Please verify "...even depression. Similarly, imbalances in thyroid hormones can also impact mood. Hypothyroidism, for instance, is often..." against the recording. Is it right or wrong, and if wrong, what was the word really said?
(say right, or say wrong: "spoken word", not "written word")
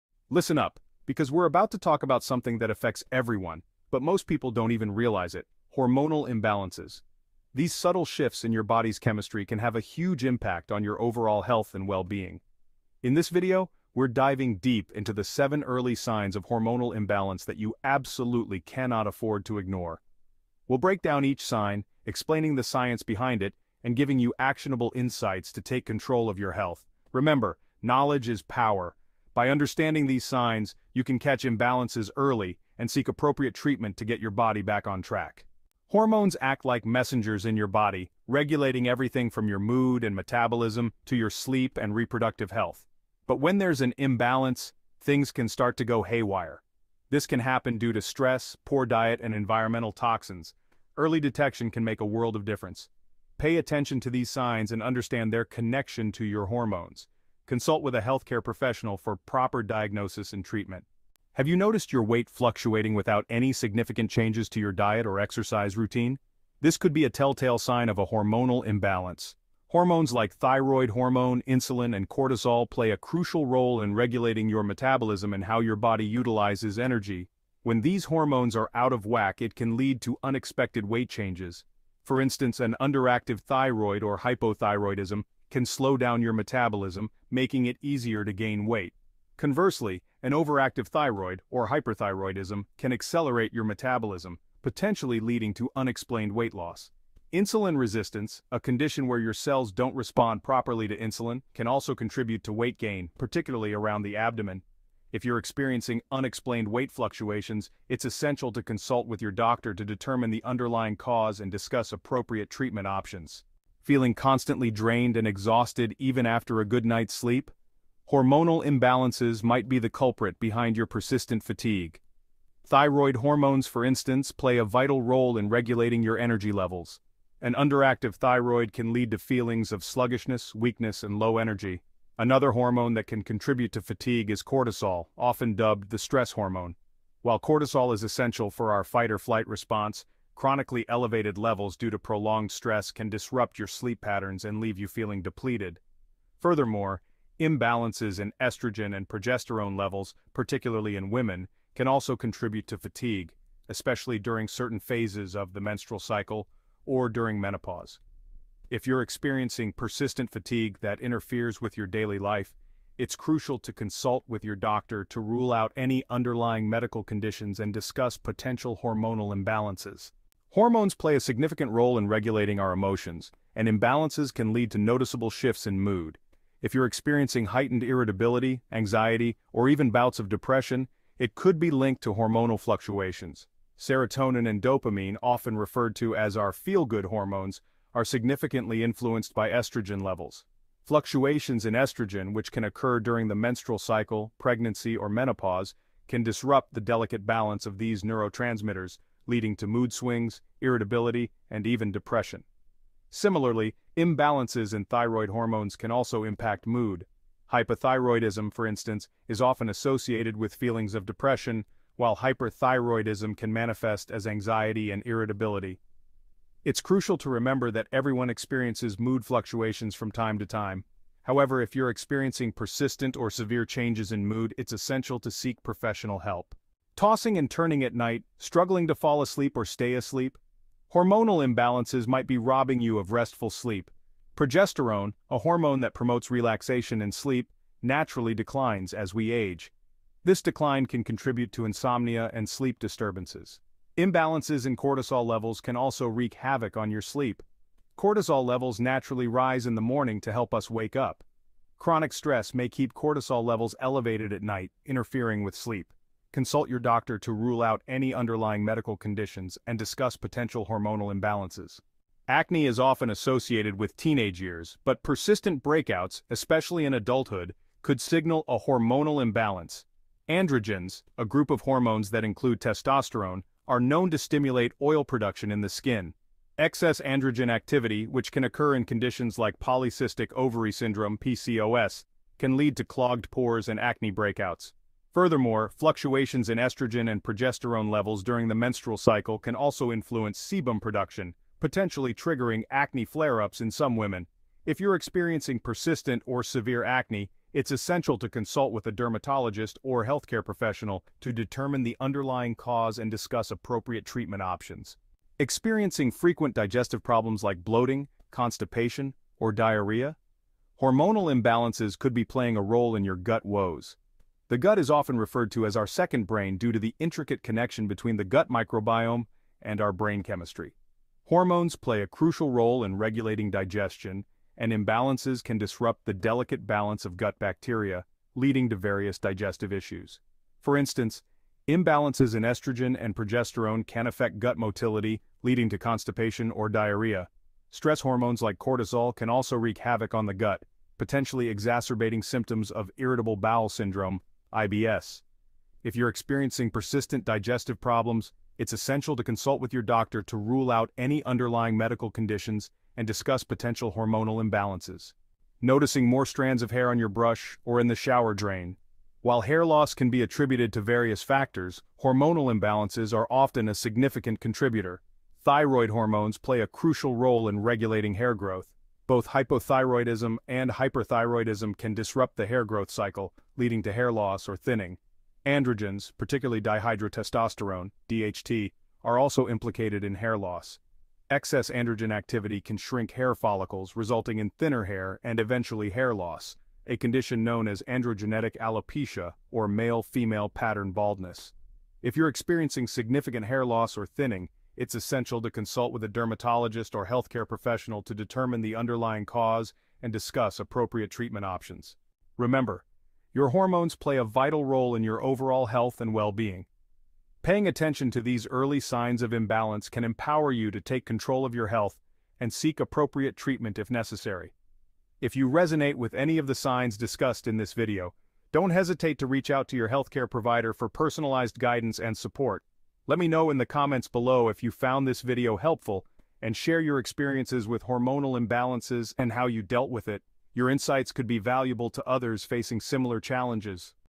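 right.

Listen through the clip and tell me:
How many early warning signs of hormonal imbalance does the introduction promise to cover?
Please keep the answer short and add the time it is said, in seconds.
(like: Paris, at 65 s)
7, at 15 s.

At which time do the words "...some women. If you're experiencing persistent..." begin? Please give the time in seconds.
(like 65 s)
293 s.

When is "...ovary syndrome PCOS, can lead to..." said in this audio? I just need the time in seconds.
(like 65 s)
280 s.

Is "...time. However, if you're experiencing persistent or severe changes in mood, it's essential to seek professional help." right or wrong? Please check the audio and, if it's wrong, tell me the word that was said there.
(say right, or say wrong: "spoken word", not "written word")
right.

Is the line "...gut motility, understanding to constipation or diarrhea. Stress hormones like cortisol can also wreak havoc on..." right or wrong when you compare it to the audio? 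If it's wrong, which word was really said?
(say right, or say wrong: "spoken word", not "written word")
wrong: "leading", not "understanding".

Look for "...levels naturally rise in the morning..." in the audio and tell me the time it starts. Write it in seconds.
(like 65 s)
248 s.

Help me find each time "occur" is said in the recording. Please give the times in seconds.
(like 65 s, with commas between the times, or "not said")
192 s, 278 s.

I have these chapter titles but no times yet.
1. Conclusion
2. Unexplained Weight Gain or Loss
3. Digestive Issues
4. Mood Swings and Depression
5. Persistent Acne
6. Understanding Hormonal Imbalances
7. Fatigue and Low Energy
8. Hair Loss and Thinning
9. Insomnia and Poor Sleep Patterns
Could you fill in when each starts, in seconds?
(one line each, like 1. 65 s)
1. 402 s
2. 61 s
3. 305 s
4. 170 s
5. 262 s
6. 35 s
7. 113 s
8. 355 s
9. 226 s.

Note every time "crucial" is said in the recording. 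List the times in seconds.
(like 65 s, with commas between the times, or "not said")
72 s, 163 s, 216 s, 322 s, 366 s.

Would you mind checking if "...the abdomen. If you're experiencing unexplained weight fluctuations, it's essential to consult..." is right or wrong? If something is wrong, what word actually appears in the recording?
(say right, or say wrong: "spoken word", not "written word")
right.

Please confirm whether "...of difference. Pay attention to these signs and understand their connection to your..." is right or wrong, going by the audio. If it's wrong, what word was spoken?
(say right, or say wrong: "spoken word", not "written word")
right.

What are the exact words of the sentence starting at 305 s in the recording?
Experiencing frequent digestive problems like bloating, constipation, or diarrhea?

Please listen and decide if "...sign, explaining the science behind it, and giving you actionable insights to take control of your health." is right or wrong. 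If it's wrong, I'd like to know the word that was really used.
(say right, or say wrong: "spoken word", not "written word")
right.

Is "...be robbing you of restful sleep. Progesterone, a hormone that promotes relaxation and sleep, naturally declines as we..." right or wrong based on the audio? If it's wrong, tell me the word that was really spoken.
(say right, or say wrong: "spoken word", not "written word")
right.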